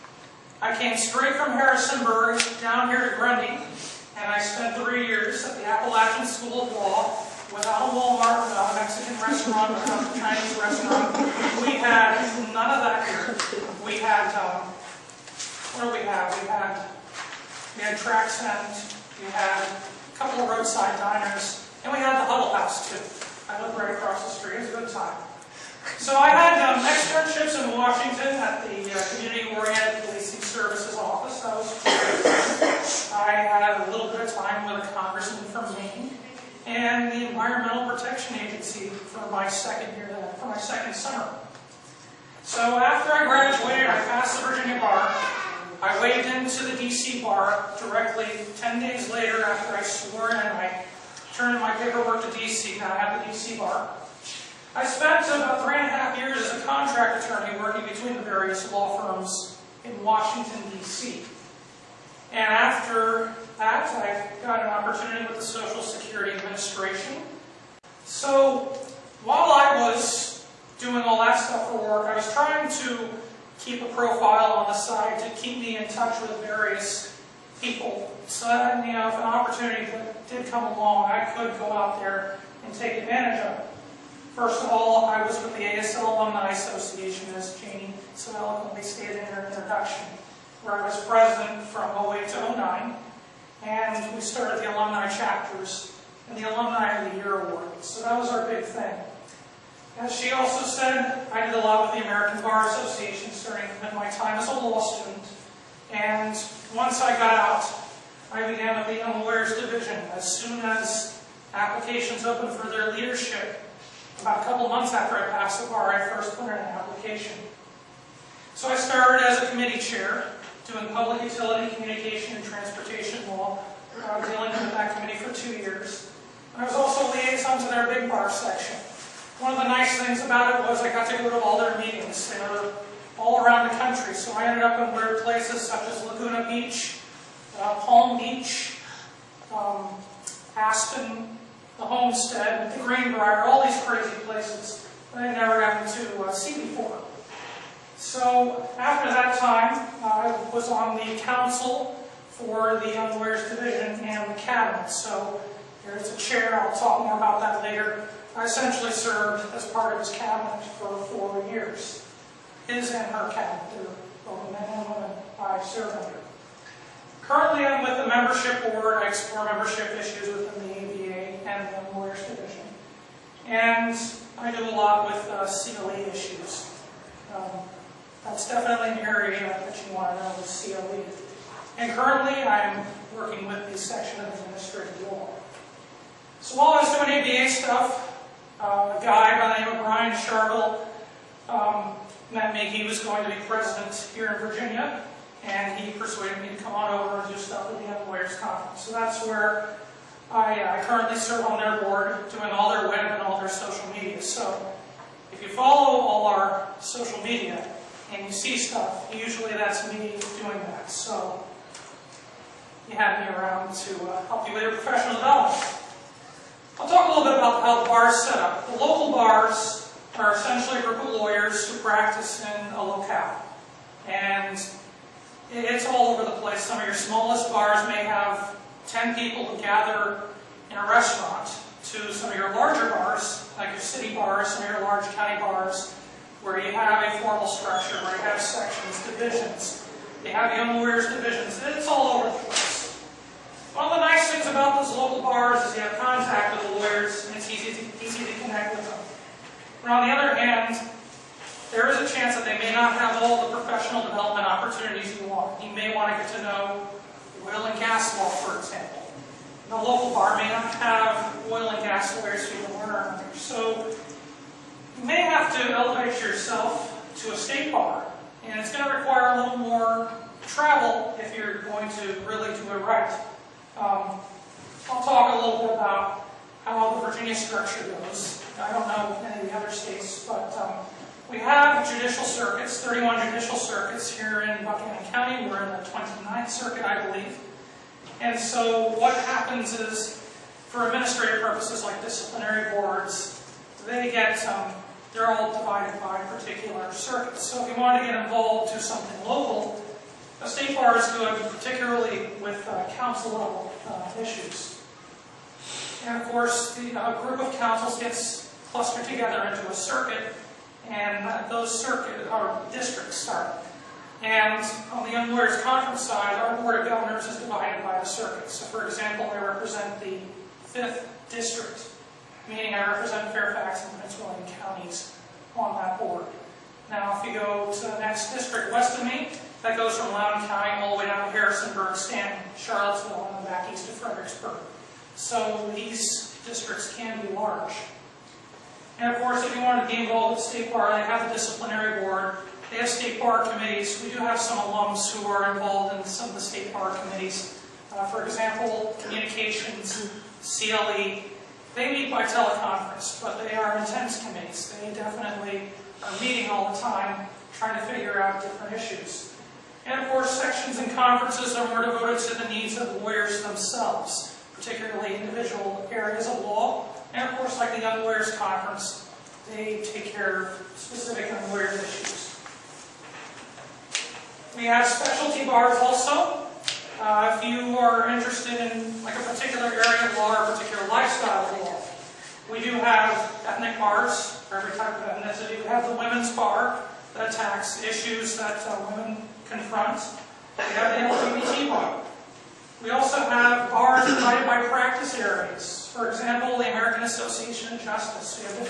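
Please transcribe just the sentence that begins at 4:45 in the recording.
We're in the 29th circuit, I believe.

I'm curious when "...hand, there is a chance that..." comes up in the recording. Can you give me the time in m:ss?
4:10.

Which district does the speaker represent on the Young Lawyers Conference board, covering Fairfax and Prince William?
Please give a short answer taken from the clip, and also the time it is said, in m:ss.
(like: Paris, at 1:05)
5th District, at 5:20.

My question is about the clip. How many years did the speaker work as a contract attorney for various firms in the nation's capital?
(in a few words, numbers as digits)
three and a half years.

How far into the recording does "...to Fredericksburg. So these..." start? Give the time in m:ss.
5:33.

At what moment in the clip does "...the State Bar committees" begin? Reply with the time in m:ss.
5:46.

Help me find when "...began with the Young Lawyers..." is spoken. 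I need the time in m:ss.
1:48.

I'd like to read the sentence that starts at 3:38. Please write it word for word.
The local bars are essentially a group of lawyers who practice in a locale.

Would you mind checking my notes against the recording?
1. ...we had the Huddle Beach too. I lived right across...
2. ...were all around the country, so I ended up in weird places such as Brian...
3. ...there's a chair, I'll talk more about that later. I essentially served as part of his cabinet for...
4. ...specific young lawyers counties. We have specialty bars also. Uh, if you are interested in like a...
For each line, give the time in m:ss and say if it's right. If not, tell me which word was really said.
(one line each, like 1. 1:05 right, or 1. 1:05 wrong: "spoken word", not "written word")
1. 0:21 wrong: "House", not "Beach"
2. 2:12 wrong: "Laguna", not "Brian"
3. 2:35 right
4. 6:10 wrong: "issues", not "counties".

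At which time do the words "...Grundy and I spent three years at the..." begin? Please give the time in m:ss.
0:03.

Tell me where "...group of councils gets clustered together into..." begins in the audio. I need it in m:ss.
5:07.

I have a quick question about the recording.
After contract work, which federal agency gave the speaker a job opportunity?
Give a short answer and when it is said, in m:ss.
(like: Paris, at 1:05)
Social Security Administration, at 1:05.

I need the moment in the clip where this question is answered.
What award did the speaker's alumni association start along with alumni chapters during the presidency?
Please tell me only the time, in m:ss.
1:36.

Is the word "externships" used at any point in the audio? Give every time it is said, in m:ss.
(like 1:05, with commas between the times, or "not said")
0:26.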